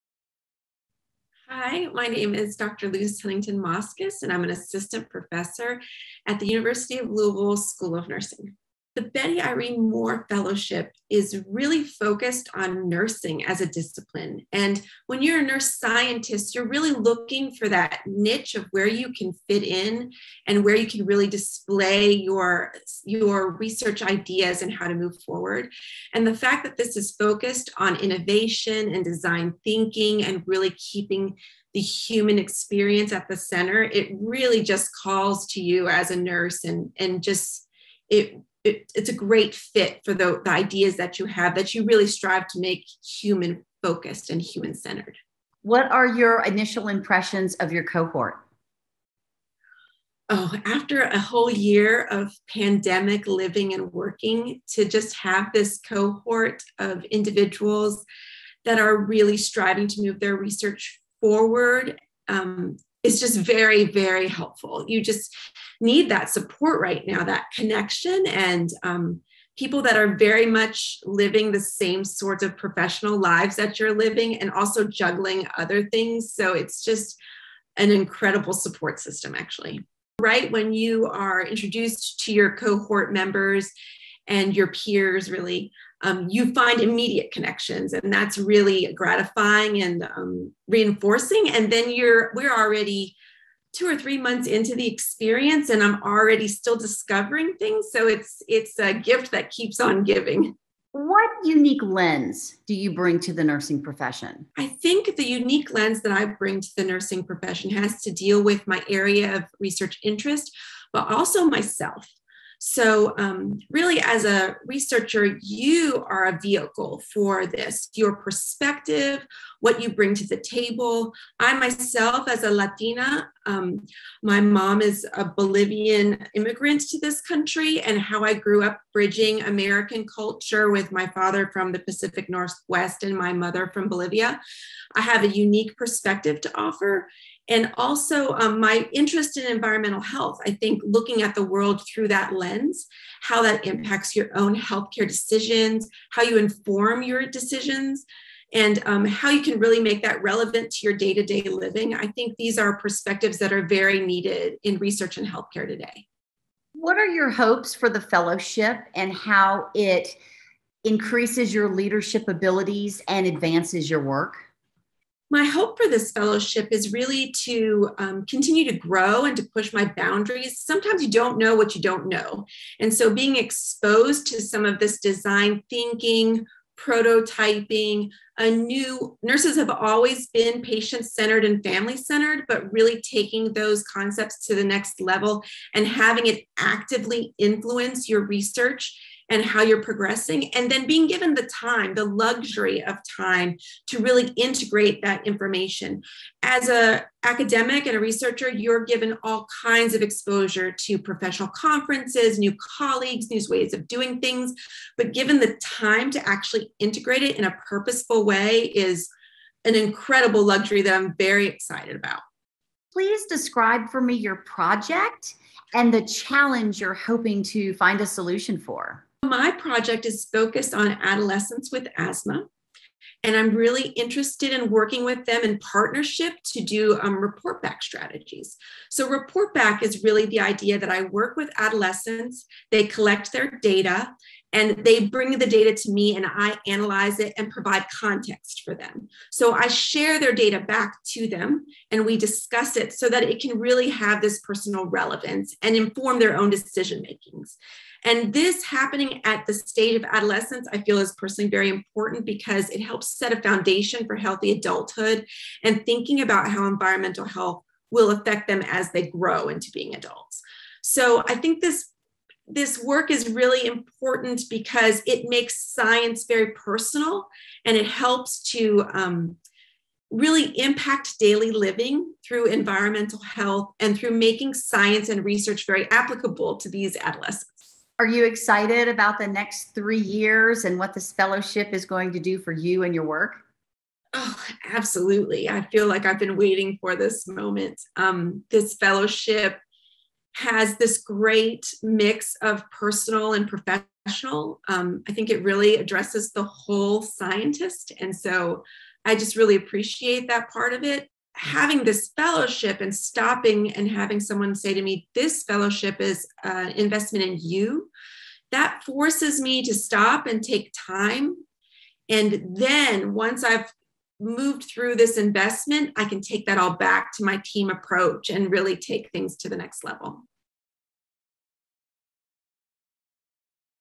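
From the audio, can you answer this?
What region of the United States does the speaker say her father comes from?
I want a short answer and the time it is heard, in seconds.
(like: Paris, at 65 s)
Pacific Northwest, at 131 s.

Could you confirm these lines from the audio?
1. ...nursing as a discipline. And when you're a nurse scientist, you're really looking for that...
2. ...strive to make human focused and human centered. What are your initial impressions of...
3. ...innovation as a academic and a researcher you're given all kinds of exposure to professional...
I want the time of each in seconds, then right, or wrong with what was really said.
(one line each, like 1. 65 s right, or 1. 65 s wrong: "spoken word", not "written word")
1. 12 s right
2. 42 s right
3. 195 s wrong: "information", not "innovation".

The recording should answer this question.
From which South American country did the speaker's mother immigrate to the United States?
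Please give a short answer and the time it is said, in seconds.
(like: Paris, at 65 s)
Bolivia, at 125 s.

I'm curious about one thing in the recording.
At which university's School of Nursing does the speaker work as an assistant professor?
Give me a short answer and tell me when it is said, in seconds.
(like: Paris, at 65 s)
University of Louisville, at 6 s.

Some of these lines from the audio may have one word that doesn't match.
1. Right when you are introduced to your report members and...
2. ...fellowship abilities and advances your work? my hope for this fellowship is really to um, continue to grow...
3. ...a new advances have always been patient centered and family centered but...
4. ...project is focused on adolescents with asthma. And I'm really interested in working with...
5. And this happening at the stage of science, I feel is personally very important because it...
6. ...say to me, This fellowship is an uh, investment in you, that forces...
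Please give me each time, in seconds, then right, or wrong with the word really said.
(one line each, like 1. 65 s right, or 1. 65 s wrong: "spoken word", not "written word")
1. 80 s wrong: "cohort", not "report"
2. 161 s wrong: "leadership", not "fellowship"
3. 178 s wrong: "nurses", not "advances"
4. 219 s right
5. 248 s wrong: "adolescence", not "science"
6. 304 s right.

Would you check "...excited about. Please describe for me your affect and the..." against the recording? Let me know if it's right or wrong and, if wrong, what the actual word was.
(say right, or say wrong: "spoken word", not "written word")
wrong: "project", not "affect".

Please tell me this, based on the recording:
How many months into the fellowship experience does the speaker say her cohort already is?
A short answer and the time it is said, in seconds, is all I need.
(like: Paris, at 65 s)
2 or 3, at 93 s.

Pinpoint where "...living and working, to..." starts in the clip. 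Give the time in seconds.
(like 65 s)
53 s.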